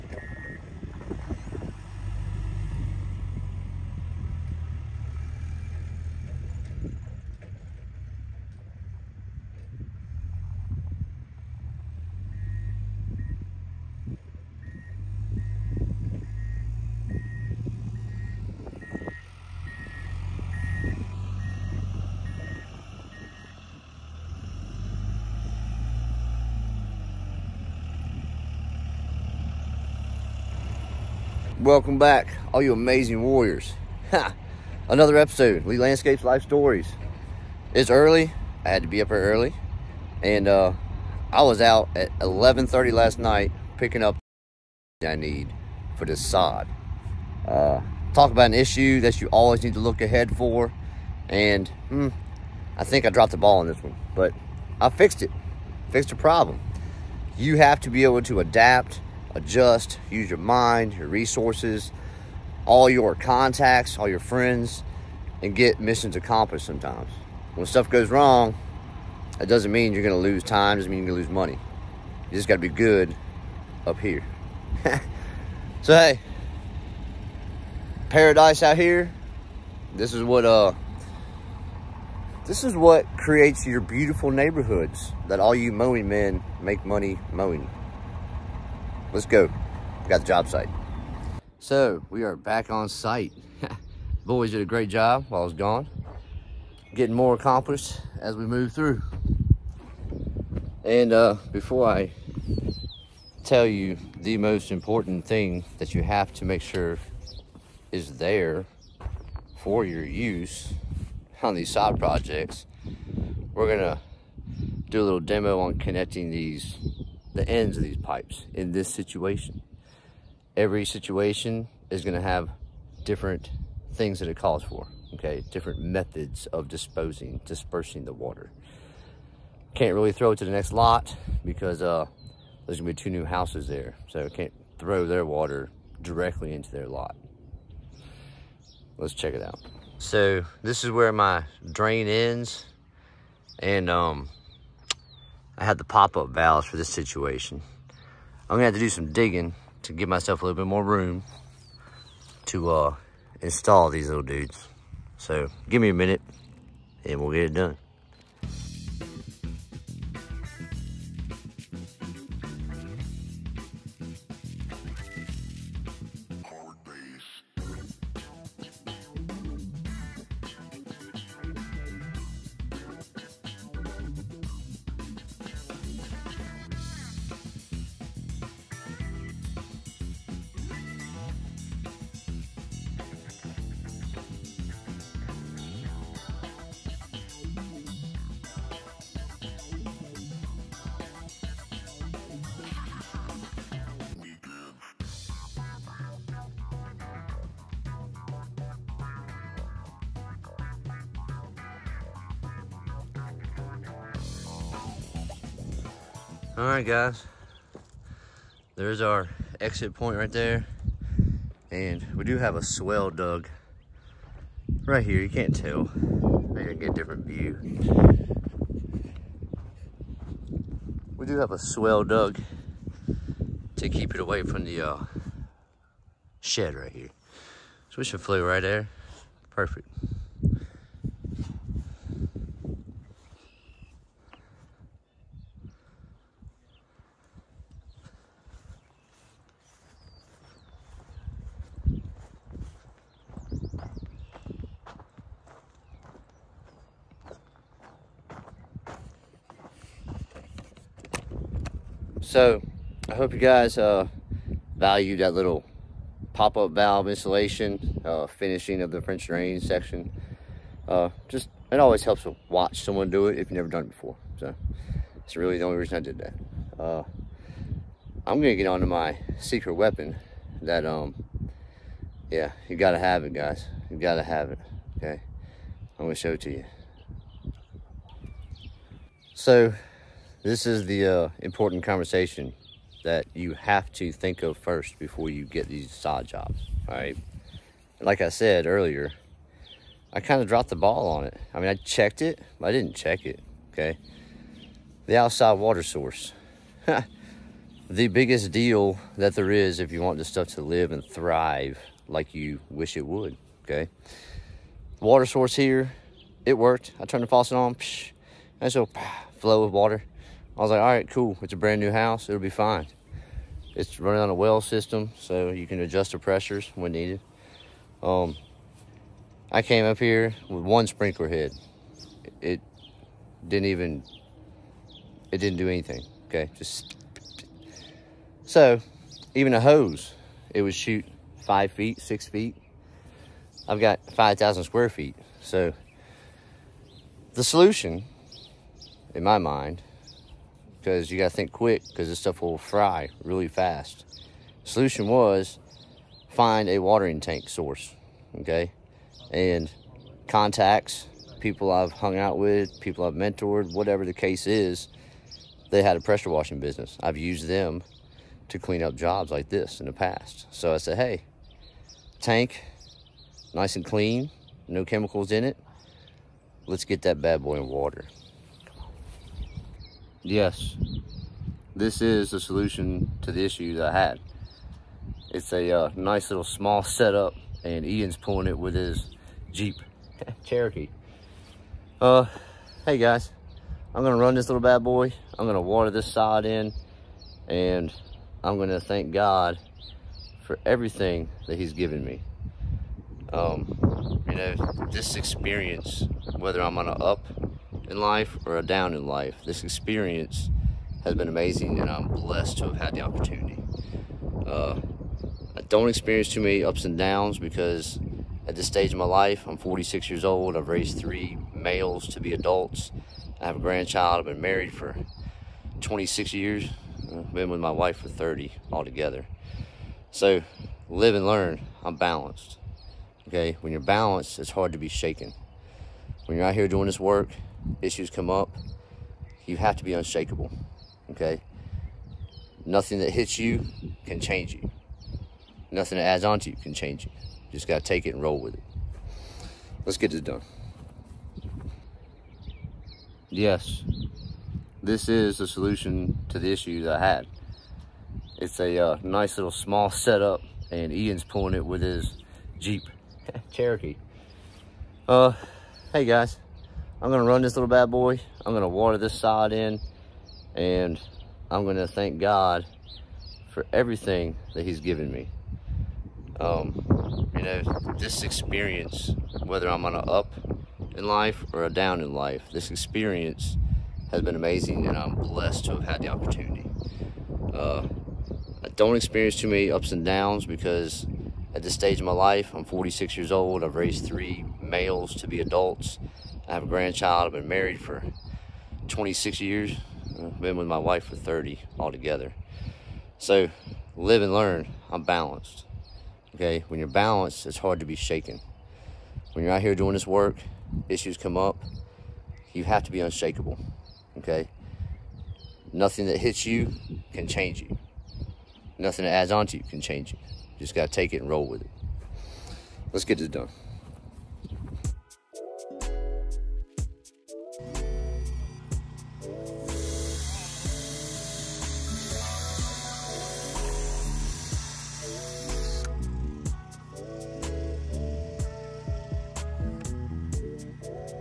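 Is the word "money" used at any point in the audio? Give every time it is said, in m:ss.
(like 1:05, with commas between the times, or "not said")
1:11, 1:26.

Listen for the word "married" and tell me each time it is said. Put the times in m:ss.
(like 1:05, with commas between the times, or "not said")
6:54, 8:07.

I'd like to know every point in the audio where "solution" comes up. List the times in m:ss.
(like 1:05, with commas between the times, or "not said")
5:37, 5:44, 6:12, 7:25.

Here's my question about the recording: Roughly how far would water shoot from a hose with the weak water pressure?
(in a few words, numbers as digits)
5 or 6 feet.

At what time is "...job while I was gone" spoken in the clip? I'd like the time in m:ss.
1:34.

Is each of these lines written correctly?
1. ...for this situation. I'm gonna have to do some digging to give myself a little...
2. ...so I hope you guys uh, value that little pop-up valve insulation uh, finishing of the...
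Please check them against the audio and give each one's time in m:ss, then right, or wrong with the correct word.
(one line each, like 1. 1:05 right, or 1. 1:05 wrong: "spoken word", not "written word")
1. 2:26 right
2. 4:12 right.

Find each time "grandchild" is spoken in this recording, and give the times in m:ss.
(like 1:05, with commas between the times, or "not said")
6:53, 8:06.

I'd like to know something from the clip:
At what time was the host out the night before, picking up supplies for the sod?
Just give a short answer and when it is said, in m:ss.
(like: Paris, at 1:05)
11:30, at 0:42.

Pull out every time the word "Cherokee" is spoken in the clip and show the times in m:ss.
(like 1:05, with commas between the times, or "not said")
6:20, 7:33.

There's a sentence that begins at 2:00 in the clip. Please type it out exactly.
Every situation is gonna have different things that it calls for, okay?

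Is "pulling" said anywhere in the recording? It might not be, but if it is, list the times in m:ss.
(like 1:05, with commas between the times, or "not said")
6:18, 7:31.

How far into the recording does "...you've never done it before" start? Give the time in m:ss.
4:23.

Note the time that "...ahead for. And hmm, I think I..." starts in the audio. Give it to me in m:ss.
0:50.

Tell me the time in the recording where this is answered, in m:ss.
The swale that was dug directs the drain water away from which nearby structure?
3:46.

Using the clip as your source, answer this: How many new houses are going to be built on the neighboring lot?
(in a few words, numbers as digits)
2.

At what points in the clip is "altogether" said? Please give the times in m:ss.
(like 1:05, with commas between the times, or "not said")
6:58, 8:11.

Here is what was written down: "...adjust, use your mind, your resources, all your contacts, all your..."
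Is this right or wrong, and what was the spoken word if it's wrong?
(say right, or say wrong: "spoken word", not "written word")
right.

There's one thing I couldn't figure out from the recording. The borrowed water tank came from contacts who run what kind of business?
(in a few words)
pressure washing.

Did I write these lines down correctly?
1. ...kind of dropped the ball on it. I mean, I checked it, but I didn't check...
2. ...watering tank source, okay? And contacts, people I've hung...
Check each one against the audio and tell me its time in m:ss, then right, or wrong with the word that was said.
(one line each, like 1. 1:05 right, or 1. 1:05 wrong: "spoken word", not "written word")
1. 4:50 right
2. 5:46 right.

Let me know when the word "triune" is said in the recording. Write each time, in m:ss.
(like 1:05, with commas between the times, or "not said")
not said.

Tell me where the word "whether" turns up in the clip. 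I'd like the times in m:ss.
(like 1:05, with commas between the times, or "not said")
6:36, 7:49.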